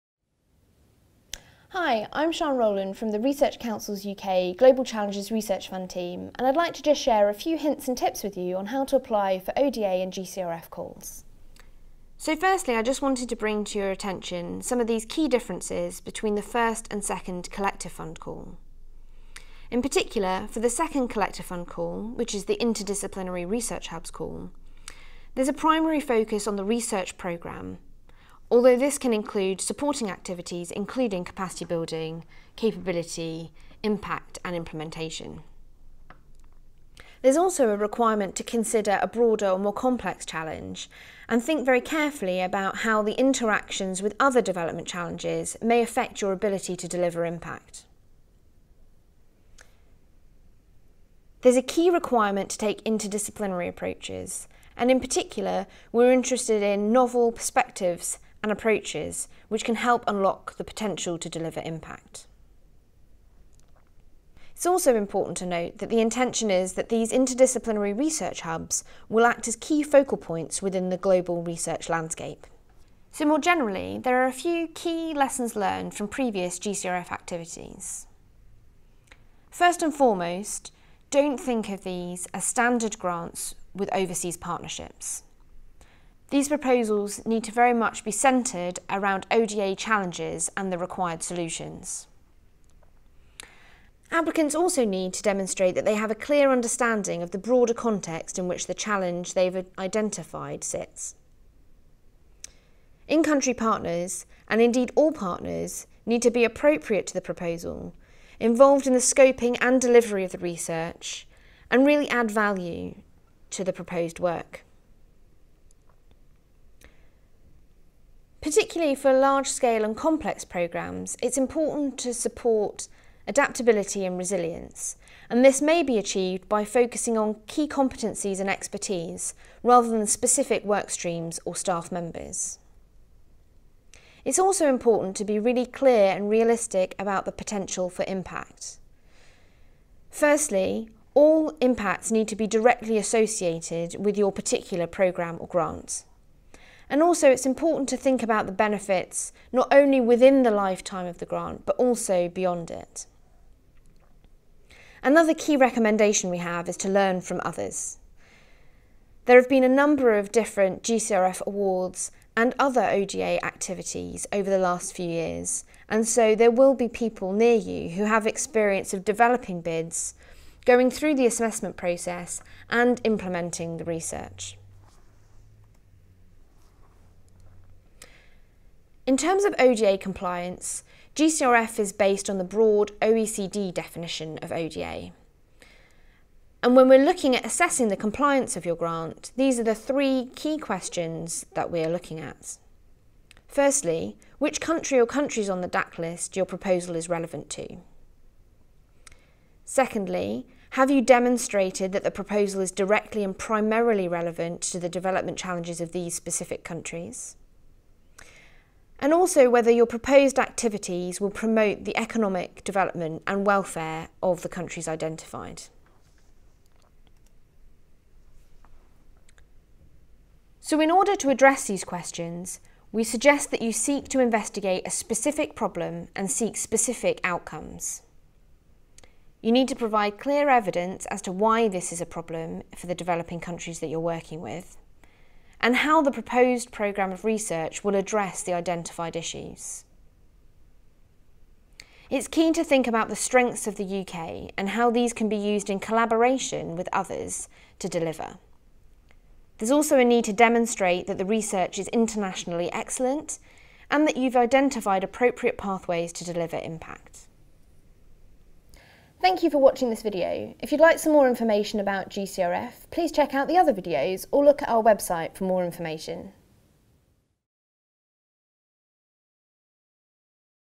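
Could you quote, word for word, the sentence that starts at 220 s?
So, in order to address these questions, we suggest that you seek to investigate a specific problem and seek specific outcomes.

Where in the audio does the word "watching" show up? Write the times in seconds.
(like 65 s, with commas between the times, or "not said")
259 s.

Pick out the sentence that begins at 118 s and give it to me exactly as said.
Particularly for large scale and complex programmes, it's important to support adaptability and resilience.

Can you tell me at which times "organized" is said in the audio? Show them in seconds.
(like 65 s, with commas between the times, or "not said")
not said.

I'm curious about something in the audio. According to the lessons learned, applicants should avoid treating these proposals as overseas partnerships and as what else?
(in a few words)
standard grants.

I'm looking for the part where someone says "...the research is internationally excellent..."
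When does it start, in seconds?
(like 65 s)
251 s.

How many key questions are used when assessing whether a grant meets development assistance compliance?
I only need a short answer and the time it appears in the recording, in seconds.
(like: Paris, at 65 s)
3, at 189 s.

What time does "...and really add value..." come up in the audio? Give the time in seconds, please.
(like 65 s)
111 s.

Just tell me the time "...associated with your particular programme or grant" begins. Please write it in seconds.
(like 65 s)
142 s.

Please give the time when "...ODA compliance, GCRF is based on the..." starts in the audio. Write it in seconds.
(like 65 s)
179 s.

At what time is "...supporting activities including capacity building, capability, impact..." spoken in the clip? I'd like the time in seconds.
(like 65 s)
29 s.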